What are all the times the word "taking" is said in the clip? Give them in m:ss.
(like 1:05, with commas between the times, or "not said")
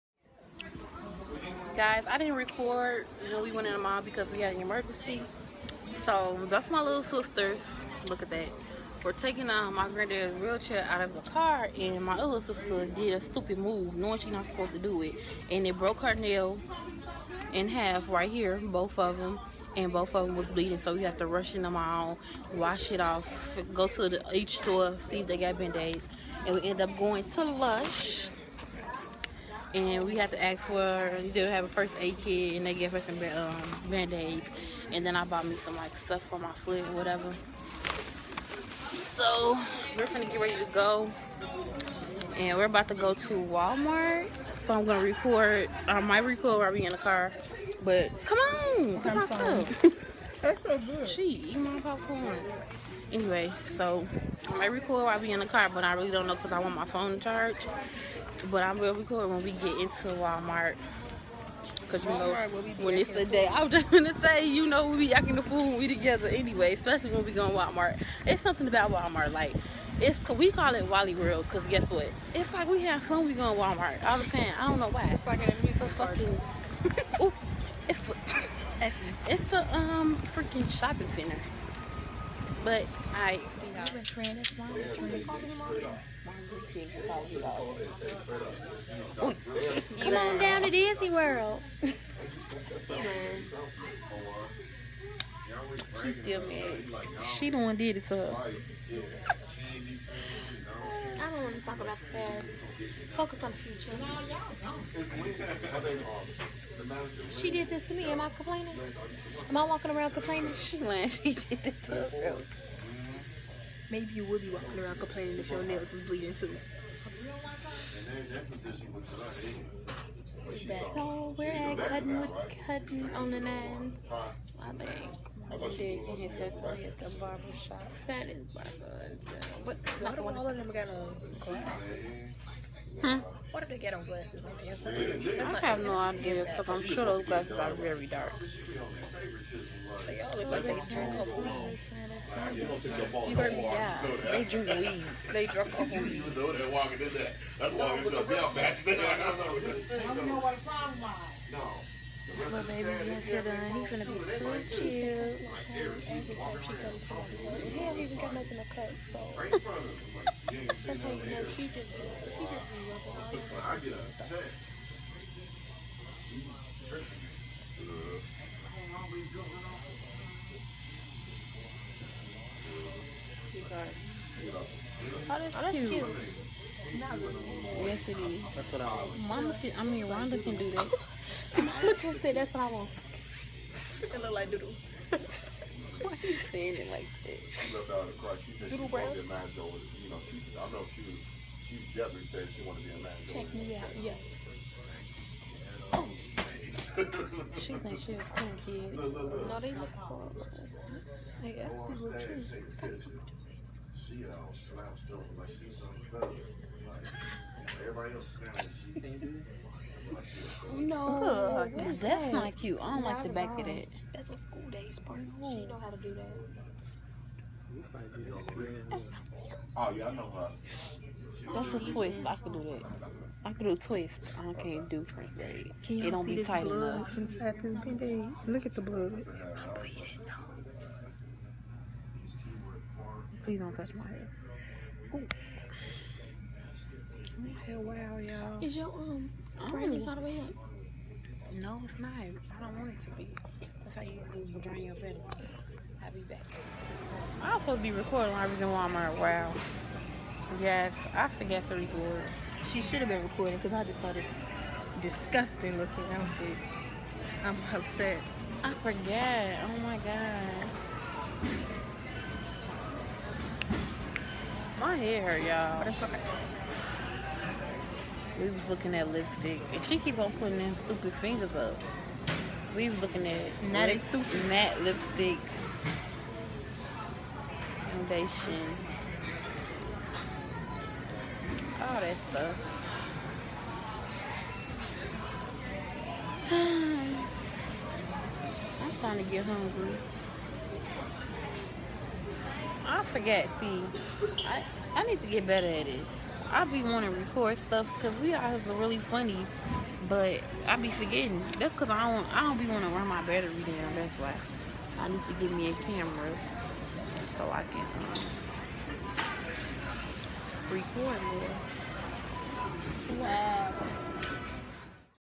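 0:09.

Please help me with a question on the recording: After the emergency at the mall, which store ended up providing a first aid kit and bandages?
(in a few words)
Lush.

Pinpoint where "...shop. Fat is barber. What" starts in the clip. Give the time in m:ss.
2:07.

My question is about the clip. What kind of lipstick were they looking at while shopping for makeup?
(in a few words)
super matte.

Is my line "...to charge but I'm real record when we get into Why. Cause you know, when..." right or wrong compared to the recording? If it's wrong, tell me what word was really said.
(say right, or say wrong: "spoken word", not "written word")
wrong: "Walmart", not "Why".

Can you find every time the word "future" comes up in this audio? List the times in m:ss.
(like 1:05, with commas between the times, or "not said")
1:43.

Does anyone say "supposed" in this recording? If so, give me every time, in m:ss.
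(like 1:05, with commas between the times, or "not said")
0:14, 4:07.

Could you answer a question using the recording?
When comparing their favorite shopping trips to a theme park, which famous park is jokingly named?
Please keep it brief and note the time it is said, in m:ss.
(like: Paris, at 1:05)
Disney World, at 1:30.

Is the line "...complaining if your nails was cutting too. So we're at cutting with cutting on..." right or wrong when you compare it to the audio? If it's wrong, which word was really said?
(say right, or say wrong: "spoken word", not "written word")
wrong: "bleeding", not "cutting".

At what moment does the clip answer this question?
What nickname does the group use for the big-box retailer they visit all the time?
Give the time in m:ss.
1:10.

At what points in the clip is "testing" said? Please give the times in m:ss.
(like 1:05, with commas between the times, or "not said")
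not said.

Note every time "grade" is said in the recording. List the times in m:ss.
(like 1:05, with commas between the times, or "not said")
3:45.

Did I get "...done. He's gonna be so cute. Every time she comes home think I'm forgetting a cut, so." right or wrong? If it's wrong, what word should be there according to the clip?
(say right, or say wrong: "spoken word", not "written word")
wrong: "making", not "forgetting".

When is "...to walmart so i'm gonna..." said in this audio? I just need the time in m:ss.
0:43.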